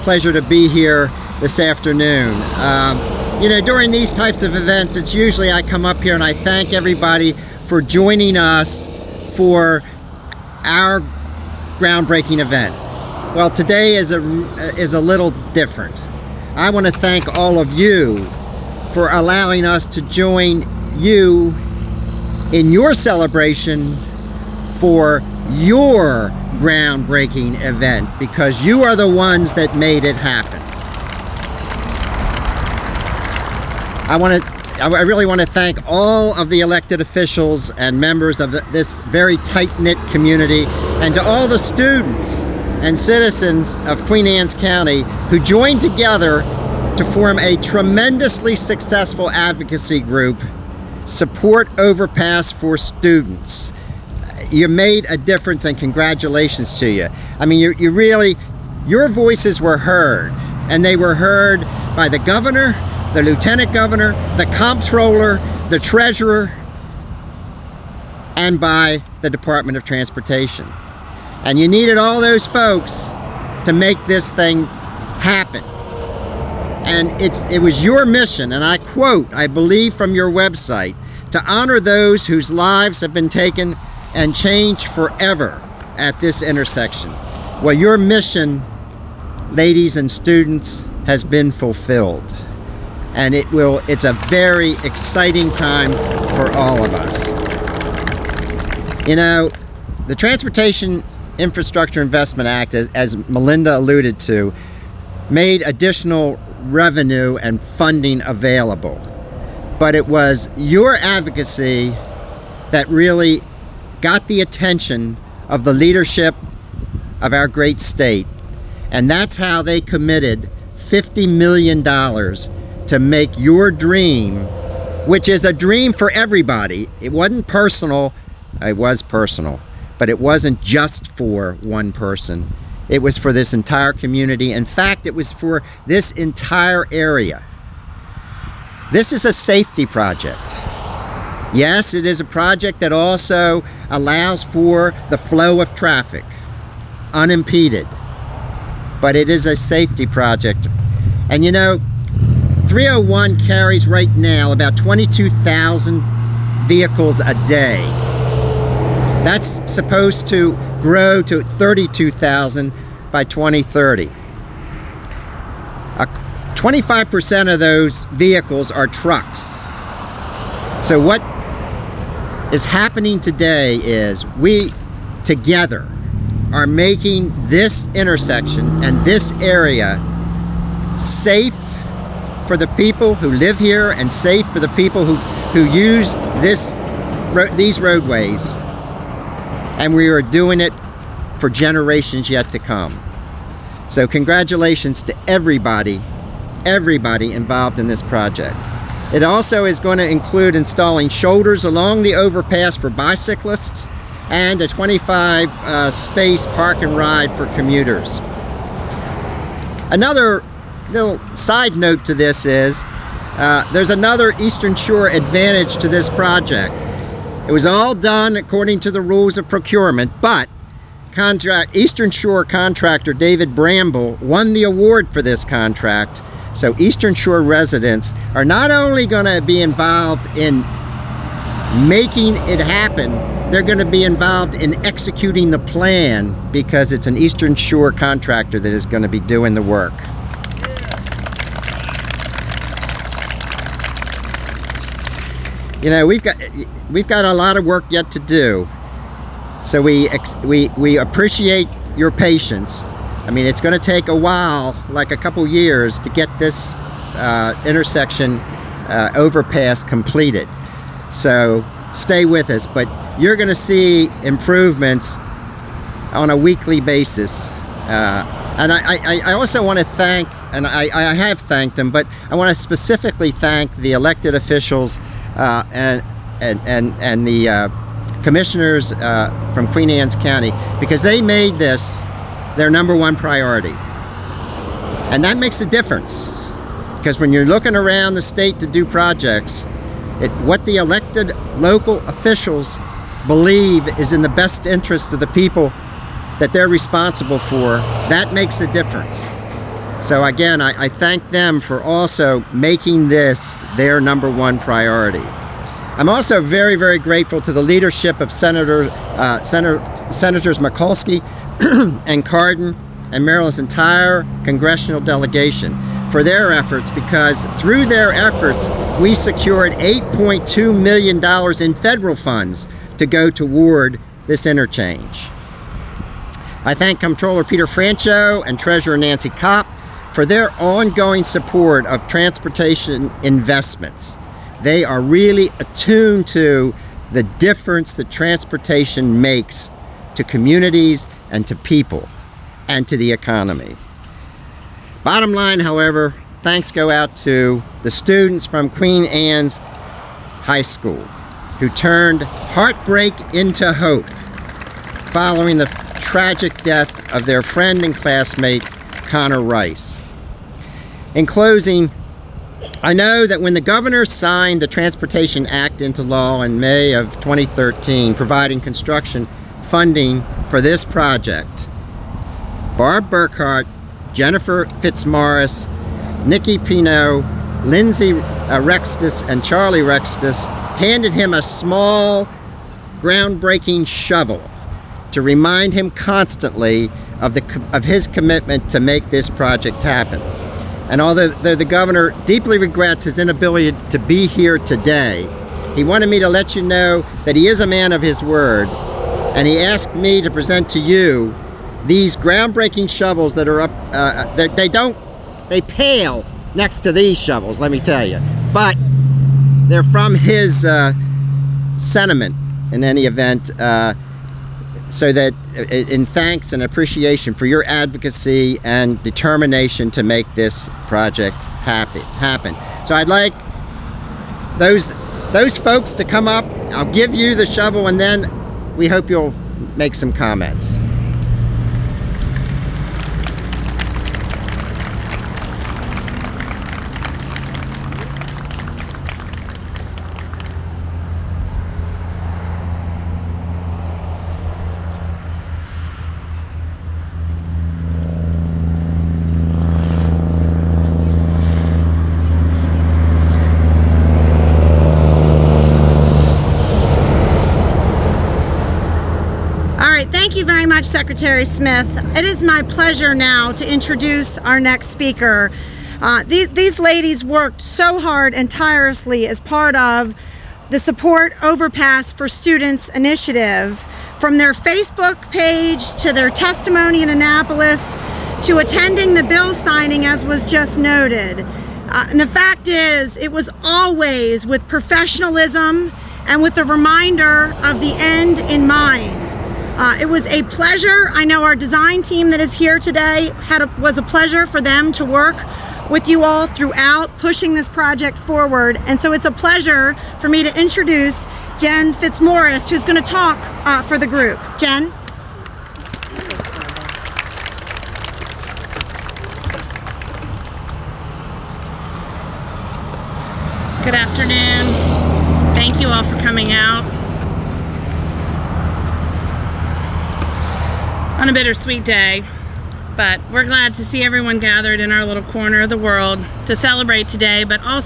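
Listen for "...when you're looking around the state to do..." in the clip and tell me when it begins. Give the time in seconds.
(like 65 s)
287 s.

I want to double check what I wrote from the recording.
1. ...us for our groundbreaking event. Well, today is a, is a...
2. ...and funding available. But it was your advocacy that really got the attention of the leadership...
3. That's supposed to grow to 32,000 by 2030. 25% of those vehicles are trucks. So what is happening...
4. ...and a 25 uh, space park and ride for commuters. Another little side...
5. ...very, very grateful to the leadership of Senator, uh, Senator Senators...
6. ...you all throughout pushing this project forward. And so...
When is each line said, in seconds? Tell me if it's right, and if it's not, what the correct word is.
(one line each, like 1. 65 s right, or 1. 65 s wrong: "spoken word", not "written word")
1. 8 s right
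2. 107 s right
3. 159 s right
4. 204 s right
5. 306 s right
6. 496 s right.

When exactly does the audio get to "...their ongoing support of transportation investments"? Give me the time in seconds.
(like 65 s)
330 s.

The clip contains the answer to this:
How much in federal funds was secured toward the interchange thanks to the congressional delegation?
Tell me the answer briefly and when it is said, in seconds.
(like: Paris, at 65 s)
$8.2 million, at 319 s.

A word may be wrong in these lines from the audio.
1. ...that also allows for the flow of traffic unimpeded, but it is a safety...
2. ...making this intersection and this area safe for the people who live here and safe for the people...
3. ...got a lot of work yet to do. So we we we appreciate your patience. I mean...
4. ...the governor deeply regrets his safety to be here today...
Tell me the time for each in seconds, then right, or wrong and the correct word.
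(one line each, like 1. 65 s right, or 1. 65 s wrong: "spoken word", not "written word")
1. 142 s right
2. 176 s right
3. 247 s right
4. 391 s wrong: "inability", not "safety".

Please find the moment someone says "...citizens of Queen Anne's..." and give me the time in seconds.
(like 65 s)
42 s.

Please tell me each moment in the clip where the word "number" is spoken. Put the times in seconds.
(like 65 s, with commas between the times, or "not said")
282 s, 304 s.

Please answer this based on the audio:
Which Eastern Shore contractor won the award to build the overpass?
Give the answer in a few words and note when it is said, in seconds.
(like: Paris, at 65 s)
David Bramble, at 223 s.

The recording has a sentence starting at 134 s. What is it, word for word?
In fact, it was for this entire area.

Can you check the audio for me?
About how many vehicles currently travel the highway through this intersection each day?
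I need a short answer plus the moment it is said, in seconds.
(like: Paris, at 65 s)
22,000, at 154 s.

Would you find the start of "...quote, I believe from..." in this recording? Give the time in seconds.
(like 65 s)
78 s.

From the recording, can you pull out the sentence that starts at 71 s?
And you needed all those folks to make this thing happen.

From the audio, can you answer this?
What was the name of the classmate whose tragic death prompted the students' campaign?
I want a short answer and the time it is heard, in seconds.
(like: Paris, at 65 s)
Connor Rice, at 358 s.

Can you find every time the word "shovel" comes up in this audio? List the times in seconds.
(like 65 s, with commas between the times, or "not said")
383 s, 402 s, 407 s, 427 s.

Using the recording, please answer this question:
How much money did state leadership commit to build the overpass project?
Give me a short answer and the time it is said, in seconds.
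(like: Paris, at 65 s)
$50 million, at 120 s.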